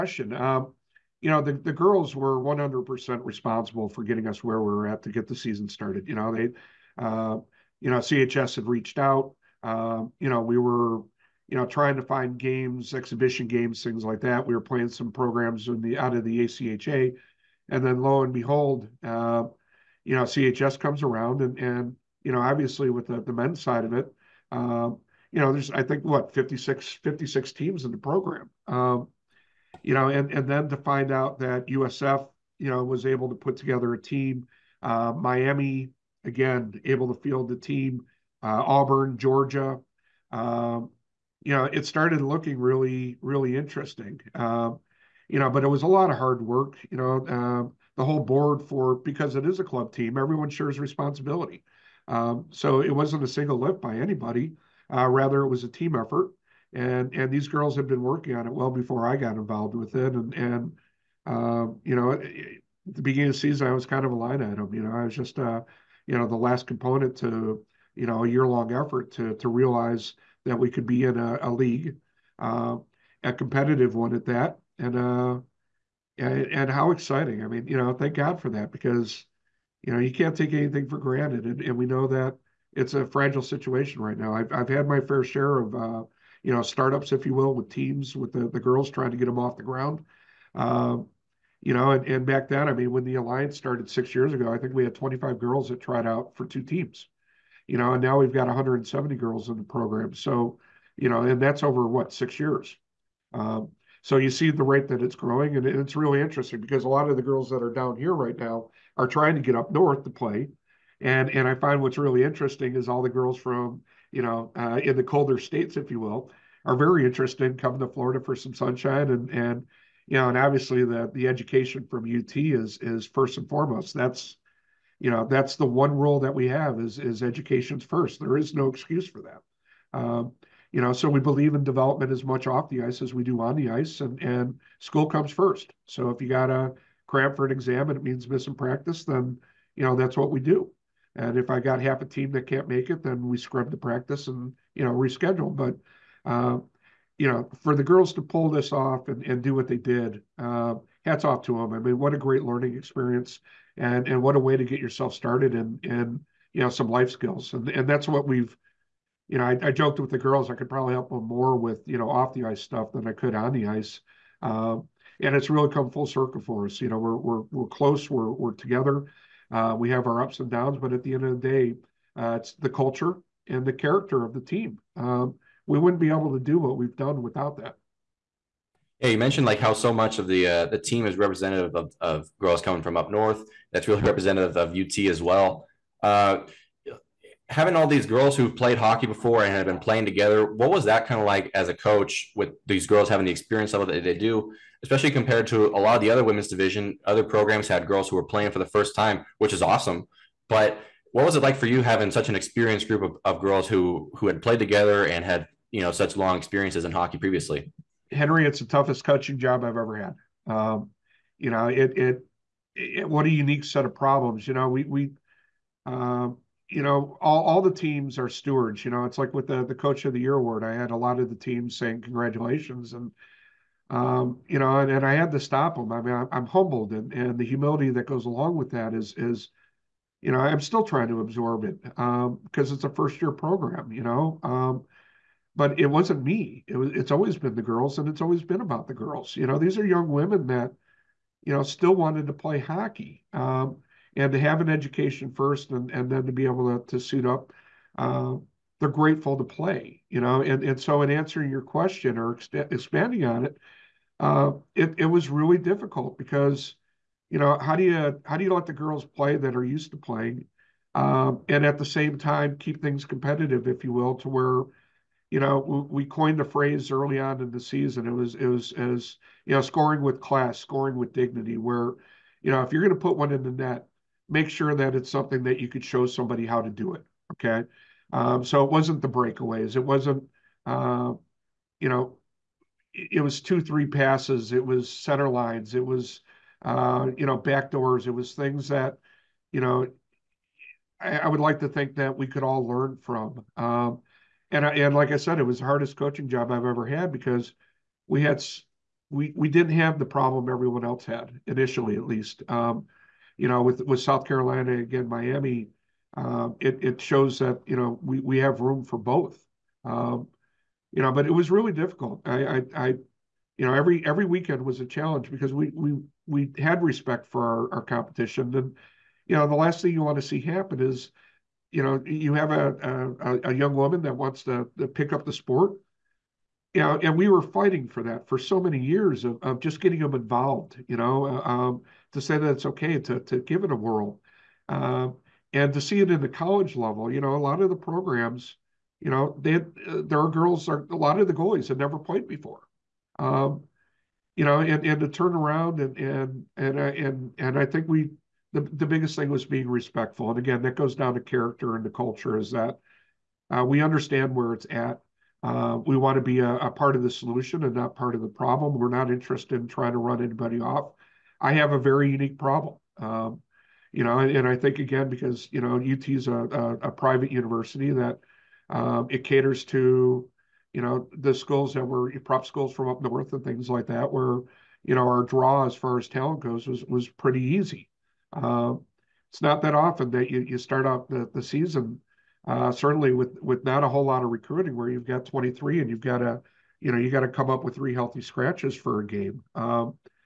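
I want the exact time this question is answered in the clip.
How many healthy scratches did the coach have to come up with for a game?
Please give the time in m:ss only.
6:27.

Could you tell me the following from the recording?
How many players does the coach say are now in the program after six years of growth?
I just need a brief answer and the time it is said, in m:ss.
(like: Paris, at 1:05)
170, at 1:38.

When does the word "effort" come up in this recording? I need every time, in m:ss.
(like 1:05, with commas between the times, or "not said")
0:55, 1:08.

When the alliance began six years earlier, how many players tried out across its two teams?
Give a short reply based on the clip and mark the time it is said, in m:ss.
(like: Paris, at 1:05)
25, at 1:34.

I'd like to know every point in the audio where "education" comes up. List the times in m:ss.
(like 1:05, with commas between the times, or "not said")
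2:01, 2:07, 4:04.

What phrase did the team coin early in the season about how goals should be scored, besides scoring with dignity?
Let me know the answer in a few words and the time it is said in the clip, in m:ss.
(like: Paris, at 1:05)
scoring with class, at 4:29.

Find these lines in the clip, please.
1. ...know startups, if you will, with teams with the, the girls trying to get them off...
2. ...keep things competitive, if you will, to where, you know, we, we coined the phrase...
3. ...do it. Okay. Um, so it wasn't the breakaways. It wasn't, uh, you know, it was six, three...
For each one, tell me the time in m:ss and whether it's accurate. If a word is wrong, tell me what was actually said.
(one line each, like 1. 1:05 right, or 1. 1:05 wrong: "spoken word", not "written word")
1. 1:26 right
2. 4:22 right
3. 4:36 wrong: "two", not "six".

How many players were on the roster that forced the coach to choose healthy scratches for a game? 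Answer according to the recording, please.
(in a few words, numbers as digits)
23.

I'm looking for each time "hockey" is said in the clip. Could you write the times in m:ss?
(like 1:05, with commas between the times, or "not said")
3:08, 3:26, 4:02.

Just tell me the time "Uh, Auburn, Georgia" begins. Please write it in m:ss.
0:38.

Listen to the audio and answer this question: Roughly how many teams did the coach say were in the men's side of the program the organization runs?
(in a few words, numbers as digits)
56.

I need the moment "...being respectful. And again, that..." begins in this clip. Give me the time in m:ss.
5:49.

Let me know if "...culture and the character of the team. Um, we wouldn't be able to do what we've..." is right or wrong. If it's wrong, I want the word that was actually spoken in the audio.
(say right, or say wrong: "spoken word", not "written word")
right.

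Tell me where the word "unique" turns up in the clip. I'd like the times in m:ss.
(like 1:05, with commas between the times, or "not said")
3:33, 6:02.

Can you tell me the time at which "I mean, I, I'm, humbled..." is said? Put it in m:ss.
3:45.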